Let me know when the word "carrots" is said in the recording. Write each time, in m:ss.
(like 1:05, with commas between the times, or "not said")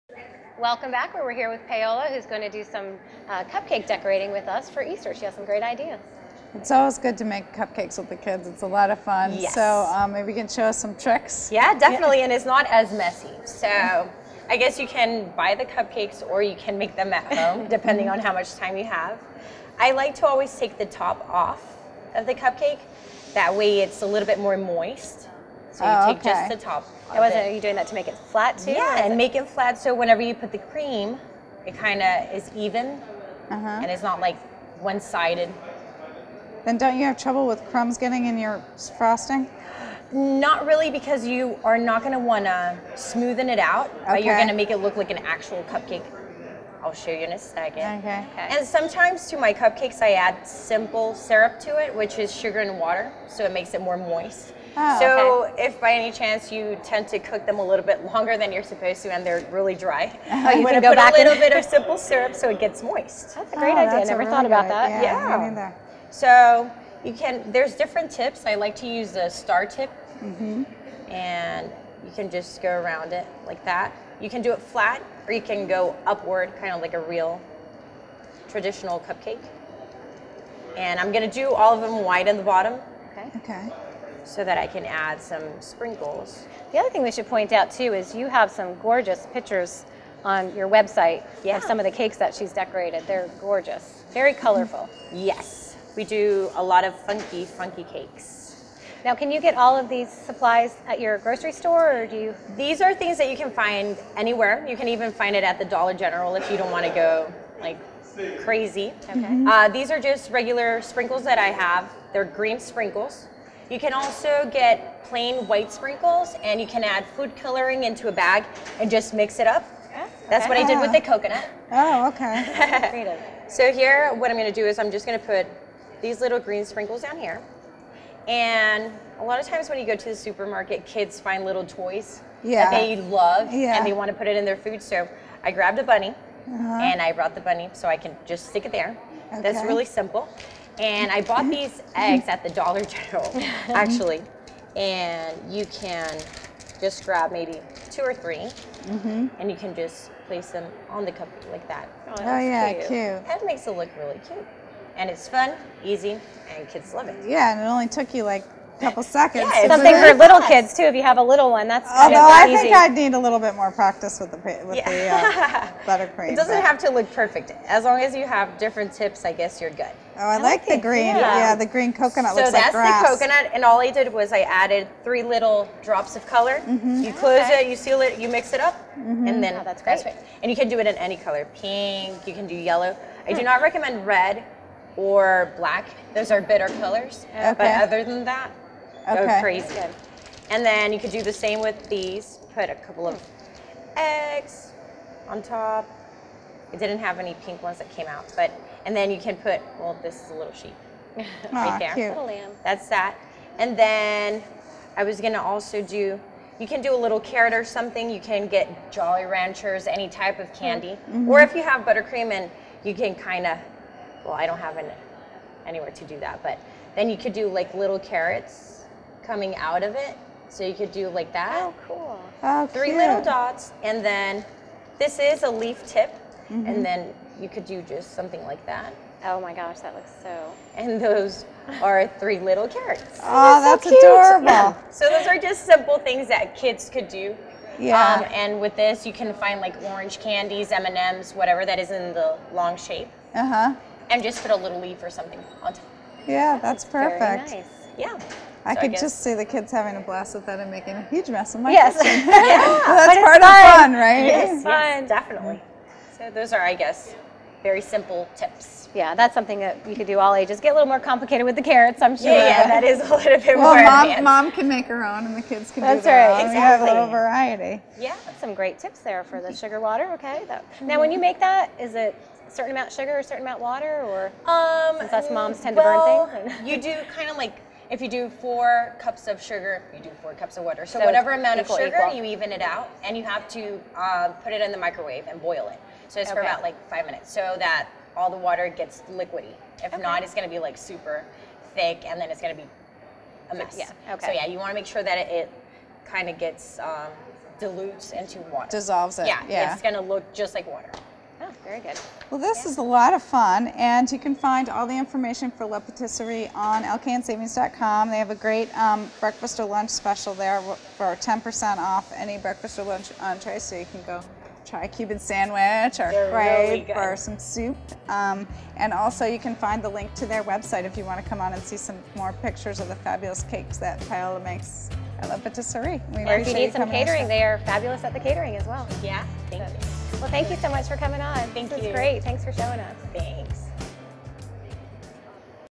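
3:27, 3:37, 3:52, 4:21.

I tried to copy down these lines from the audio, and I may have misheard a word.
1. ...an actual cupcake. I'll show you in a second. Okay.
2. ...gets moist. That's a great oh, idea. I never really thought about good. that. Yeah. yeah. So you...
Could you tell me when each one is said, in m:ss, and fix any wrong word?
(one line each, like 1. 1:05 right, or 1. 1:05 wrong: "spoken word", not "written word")
1. 0:45 right
2. 1:02 right.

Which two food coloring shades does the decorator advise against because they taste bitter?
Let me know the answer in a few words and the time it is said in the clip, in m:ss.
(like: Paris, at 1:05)
red or black, at 3:04.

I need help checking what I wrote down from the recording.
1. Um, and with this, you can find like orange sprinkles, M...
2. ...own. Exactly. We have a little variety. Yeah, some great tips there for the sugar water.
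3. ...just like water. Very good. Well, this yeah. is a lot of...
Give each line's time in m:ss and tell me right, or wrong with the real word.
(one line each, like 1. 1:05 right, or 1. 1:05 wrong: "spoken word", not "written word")
1. 3:57 wrong: "candies", not "sprinkles"
2. 4:26 right
3. 5:00 right.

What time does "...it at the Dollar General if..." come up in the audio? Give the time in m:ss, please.
1:45.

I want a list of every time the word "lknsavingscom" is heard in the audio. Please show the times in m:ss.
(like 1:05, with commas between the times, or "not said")
5:06.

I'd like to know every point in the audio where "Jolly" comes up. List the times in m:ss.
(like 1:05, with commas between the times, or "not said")
3:28.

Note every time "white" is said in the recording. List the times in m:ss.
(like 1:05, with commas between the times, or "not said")
1:22, 1:55.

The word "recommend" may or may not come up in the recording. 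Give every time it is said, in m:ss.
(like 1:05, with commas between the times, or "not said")
3:03.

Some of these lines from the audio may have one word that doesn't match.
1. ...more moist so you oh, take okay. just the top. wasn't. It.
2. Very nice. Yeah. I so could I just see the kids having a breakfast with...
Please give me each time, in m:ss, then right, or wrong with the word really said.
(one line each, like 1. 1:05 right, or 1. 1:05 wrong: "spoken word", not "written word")
1. 0:24 right
2. 4:07 wrong: "blast", not "breakfast".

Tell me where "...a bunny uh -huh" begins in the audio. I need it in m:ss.
2:15.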